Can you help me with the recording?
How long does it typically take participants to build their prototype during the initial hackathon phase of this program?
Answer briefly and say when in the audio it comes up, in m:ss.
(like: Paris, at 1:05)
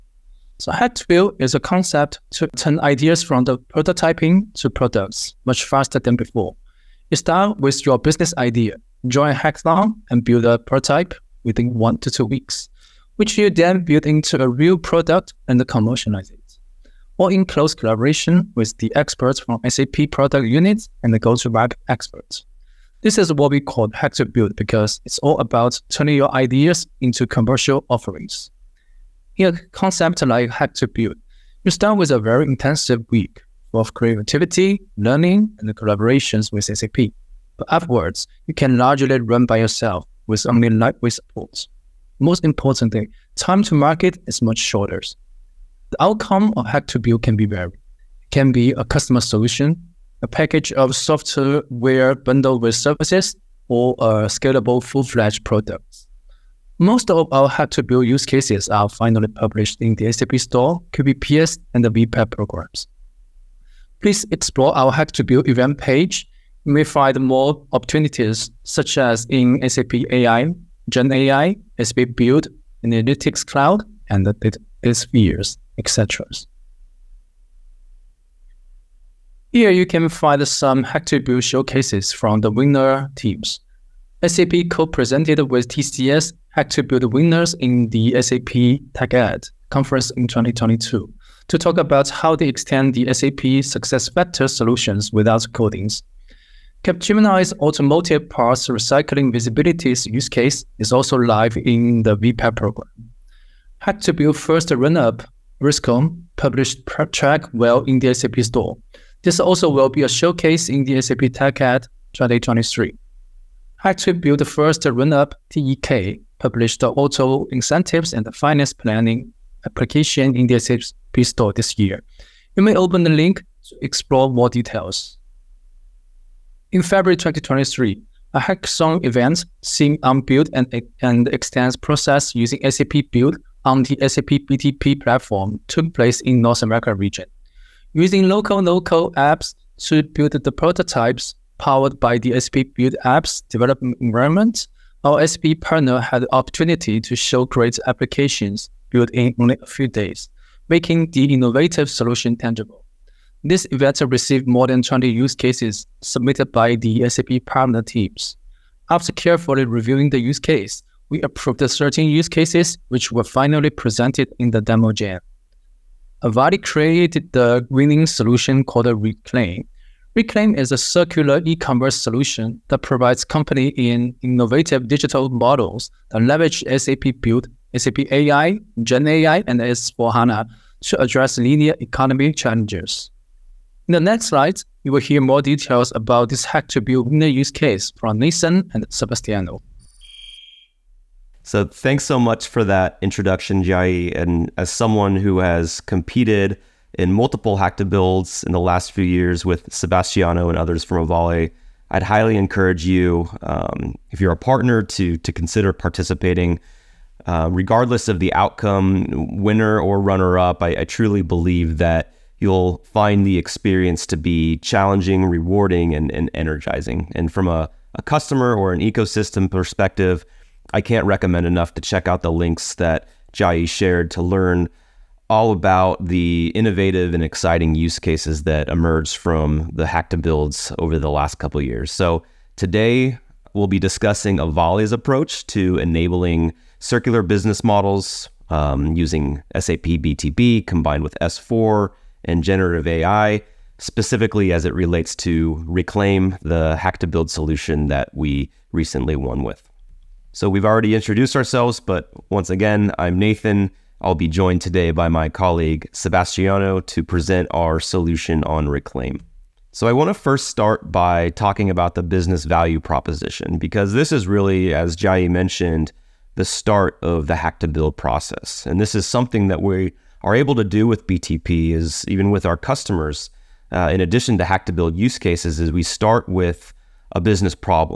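1 to 2 weeks, at 0:11.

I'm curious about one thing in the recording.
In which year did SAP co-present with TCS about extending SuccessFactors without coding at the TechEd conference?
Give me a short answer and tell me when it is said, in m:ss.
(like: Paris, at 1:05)
2022, at 1:30.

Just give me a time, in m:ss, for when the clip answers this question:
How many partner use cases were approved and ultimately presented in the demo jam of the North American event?
2:41.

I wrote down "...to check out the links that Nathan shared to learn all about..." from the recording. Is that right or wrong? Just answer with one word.
wrong.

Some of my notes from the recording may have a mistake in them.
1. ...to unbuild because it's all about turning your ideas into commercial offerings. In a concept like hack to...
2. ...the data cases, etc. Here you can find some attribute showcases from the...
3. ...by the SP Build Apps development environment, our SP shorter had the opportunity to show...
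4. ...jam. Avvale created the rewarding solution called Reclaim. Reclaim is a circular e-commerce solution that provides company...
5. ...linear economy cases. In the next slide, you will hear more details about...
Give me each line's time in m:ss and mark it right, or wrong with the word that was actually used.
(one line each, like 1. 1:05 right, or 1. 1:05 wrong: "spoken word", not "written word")
1. 0:24 wrong: "build", not "unbuild"
2. 1:14 wrong: "spheres", not "cases"
3. 2:21 wrong: "partner", not "shorter"
4. 2:44 wrong: "winning", not "rewarding"
5. 3:01 wrong: "challenges", not "cases".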